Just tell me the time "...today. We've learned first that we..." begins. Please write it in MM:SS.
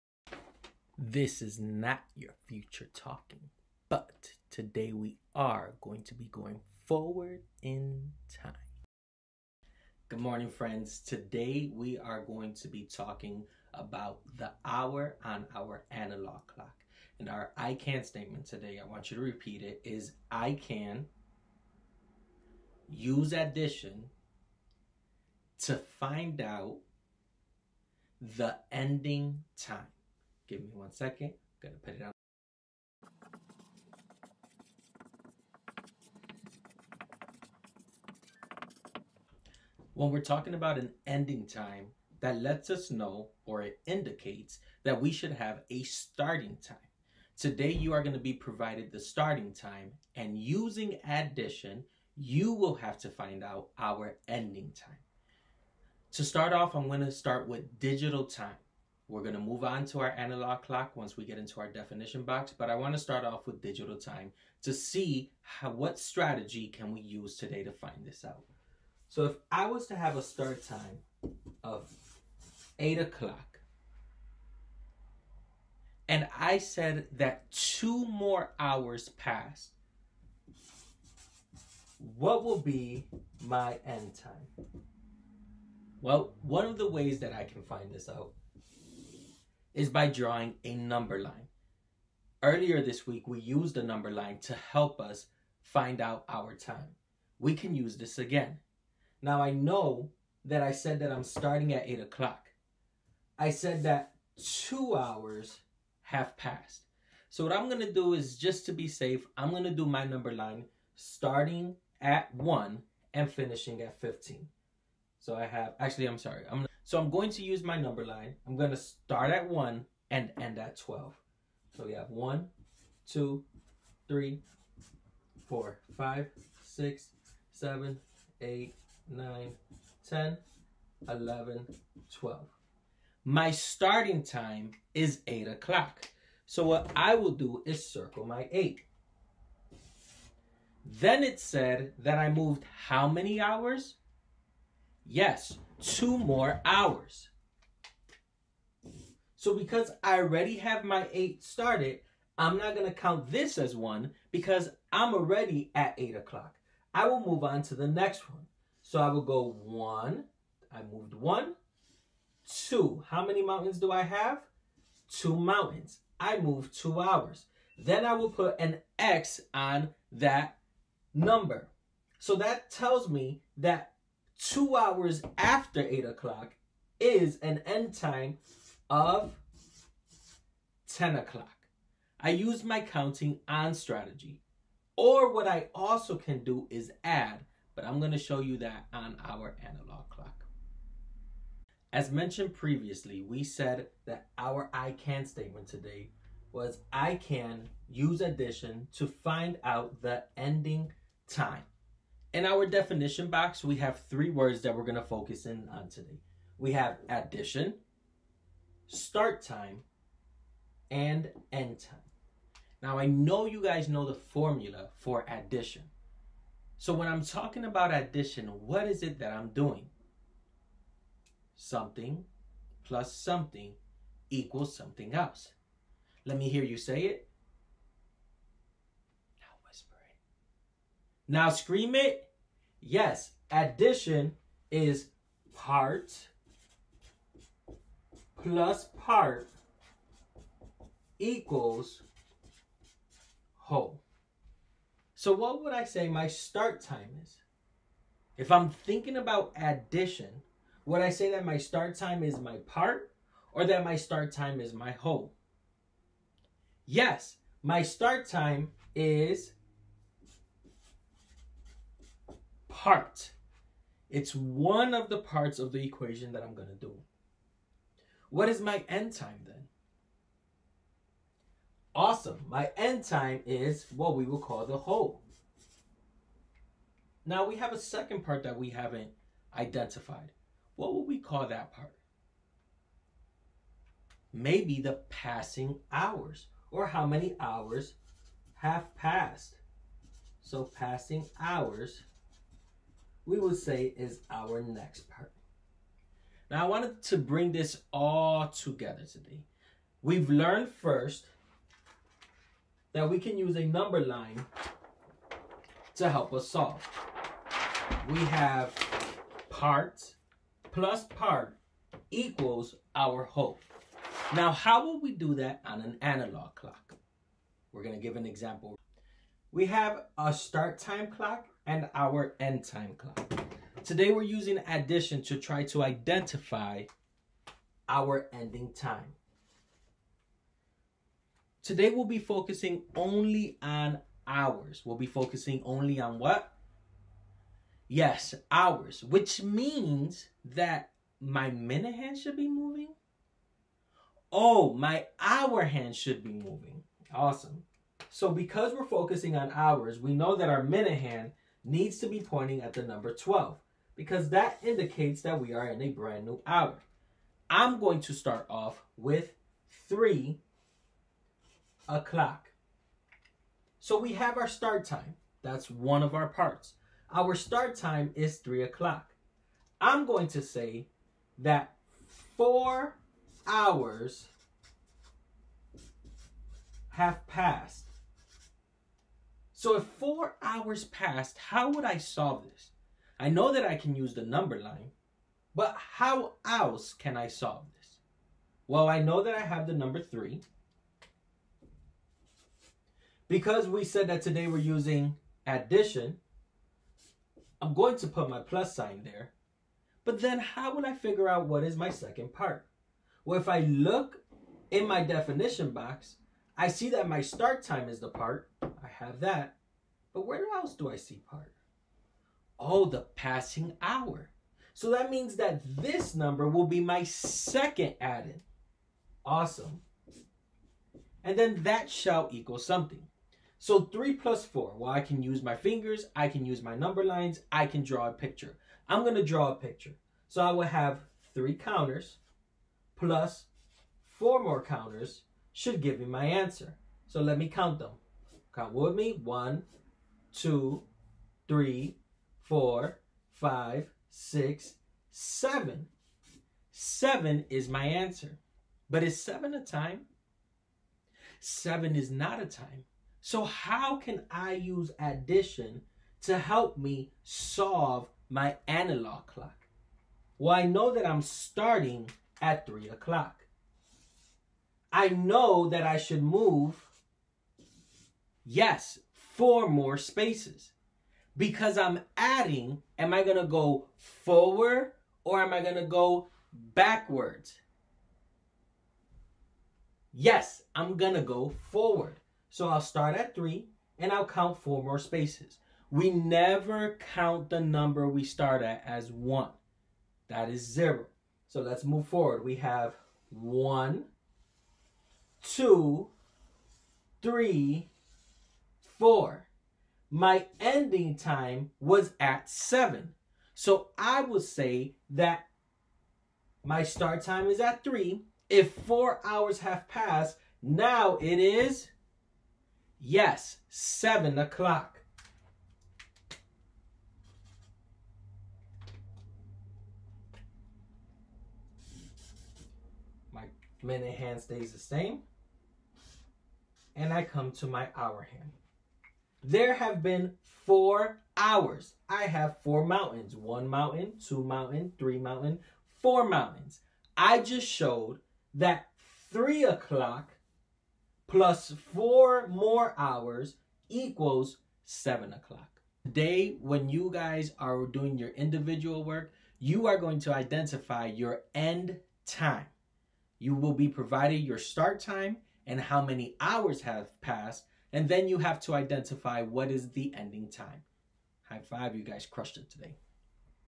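04:59.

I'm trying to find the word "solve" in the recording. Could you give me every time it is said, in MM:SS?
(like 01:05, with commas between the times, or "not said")
05:06, 06:21, 06:27, 07:37.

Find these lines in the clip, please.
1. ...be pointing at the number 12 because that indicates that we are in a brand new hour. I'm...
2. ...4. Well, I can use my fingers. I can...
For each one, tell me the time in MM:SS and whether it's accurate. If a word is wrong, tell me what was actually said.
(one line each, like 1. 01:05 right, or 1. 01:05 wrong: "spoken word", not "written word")
1. 05:52 right
2. 07:04 right.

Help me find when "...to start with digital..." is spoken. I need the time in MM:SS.
00:56.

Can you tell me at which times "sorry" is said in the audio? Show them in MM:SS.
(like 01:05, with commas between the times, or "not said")
01:56.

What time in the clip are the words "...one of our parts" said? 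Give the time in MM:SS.
06:05.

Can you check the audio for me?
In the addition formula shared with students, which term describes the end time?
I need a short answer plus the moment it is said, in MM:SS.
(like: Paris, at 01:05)
the whole, at 04:34.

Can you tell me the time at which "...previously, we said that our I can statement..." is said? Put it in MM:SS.
03:12.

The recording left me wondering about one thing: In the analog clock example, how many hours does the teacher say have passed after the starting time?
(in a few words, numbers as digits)
4.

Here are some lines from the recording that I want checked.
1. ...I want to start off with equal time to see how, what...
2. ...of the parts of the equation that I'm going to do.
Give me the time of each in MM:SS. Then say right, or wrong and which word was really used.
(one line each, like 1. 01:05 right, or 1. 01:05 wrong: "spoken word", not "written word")
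1. 01:02 wrong: "digital", not "equal"
2. 04:24 right.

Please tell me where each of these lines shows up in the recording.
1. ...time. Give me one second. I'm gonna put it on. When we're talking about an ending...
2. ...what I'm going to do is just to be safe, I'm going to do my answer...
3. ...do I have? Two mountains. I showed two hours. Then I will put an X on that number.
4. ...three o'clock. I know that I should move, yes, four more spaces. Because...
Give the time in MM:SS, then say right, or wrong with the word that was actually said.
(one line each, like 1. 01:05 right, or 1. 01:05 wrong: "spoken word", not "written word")
1. 00:29 right
2. 01:47 wrong: "number", not "answer"
3. 02:43 wrong: "moved", not "showed"
4. 07:42 right.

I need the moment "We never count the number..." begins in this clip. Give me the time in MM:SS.
08:05.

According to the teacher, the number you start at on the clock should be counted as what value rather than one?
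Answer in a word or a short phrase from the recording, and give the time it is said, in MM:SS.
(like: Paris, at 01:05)
0, at 08:10.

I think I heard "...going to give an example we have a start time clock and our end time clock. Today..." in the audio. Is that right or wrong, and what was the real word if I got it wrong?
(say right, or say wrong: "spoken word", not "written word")
right.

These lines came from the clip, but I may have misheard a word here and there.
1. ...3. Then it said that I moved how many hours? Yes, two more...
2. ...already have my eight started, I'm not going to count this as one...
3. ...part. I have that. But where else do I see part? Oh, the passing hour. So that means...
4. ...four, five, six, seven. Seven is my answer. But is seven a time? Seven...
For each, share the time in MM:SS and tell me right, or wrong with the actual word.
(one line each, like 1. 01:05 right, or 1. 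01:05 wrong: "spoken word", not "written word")
1. 02:18 wrong: "8", not "3"
2. 02:30 right
3. 06:48 right
4. 07:22 right.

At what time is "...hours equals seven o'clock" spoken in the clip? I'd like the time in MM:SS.
09:02.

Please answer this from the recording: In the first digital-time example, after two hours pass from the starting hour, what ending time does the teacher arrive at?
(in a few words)
10 o'clock.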